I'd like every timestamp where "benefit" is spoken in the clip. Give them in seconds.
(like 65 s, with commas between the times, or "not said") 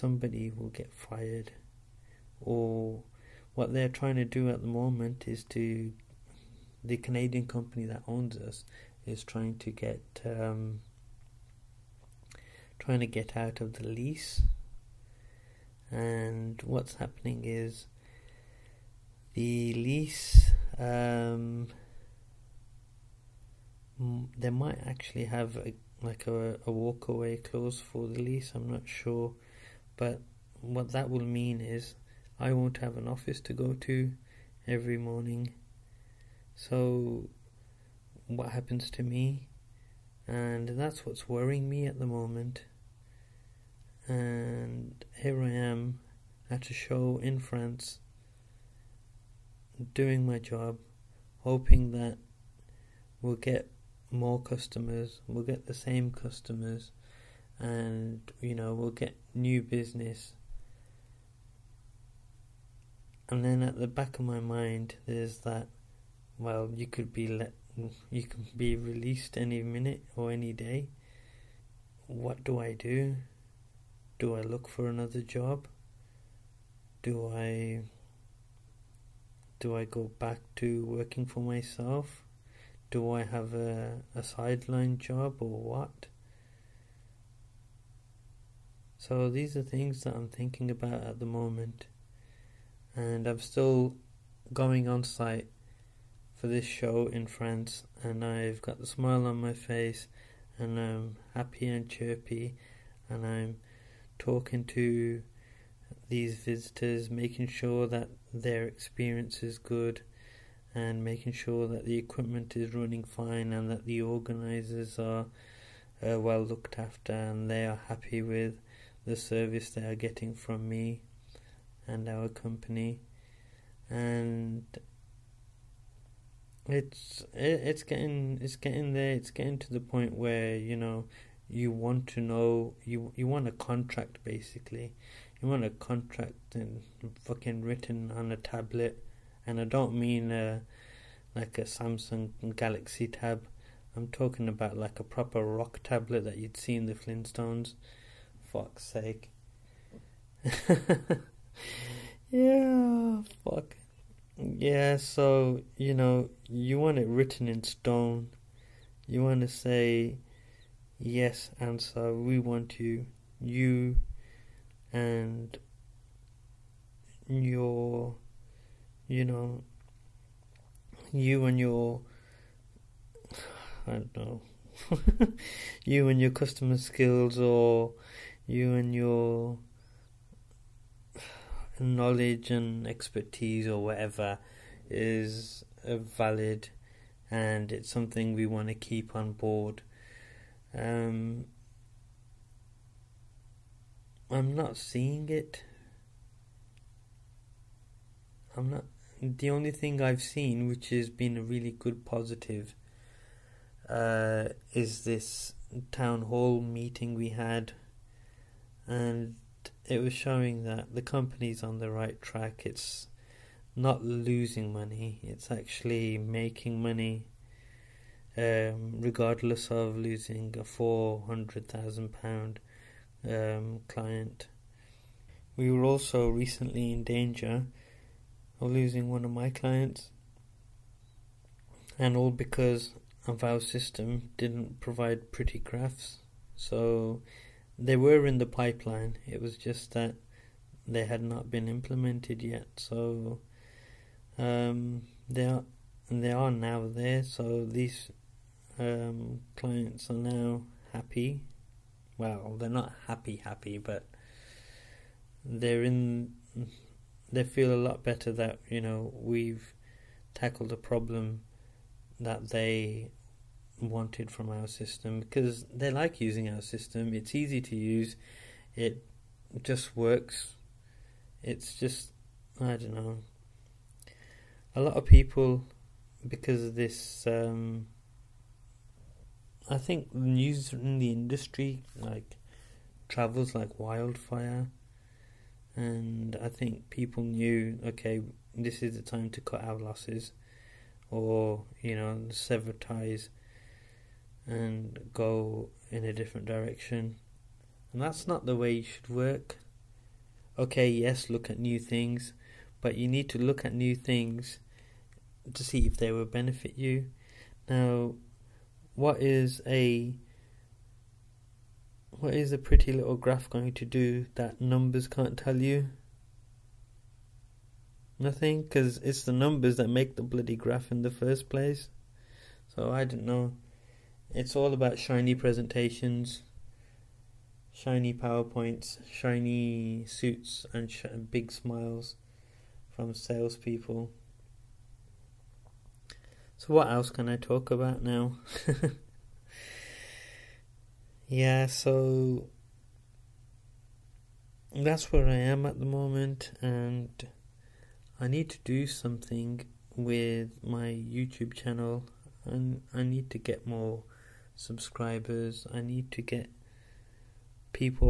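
306 s.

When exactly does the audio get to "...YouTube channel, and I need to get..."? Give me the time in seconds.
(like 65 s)
350 s.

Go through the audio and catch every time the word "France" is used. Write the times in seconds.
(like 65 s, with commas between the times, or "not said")
47 s, 97 s.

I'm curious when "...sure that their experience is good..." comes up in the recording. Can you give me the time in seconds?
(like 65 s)
107 s.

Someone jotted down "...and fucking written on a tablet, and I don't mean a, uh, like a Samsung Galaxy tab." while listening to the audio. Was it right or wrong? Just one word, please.
right.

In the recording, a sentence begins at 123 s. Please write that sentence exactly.
And it's it, it's getting it's getting there.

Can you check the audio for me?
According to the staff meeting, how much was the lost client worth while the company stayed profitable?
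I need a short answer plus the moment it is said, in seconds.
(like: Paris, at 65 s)
£400,000, at 220 s.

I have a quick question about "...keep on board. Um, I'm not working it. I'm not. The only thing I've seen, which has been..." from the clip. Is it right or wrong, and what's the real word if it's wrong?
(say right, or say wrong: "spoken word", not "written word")
wrong: "seeing", not "working".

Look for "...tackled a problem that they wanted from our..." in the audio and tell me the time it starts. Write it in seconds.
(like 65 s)
260 s.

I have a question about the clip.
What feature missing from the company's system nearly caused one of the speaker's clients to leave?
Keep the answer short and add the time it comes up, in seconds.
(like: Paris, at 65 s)
Pretty graphs, at 235 s.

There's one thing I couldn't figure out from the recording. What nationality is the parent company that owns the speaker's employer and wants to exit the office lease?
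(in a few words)
Canadian.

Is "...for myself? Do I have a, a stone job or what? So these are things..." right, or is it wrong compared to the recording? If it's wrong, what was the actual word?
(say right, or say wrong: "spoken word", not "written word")
wrong: "sideline", not "stone".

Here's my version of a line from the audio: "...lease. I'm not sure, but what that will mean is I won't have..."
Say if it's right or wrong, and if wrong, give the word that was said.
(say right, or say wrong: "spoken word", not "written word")
right.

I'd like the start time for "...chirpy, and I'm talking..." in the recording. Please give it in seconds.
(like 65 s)
101 s.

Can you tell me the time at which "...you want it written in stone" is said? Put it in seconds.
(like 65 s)
156 s.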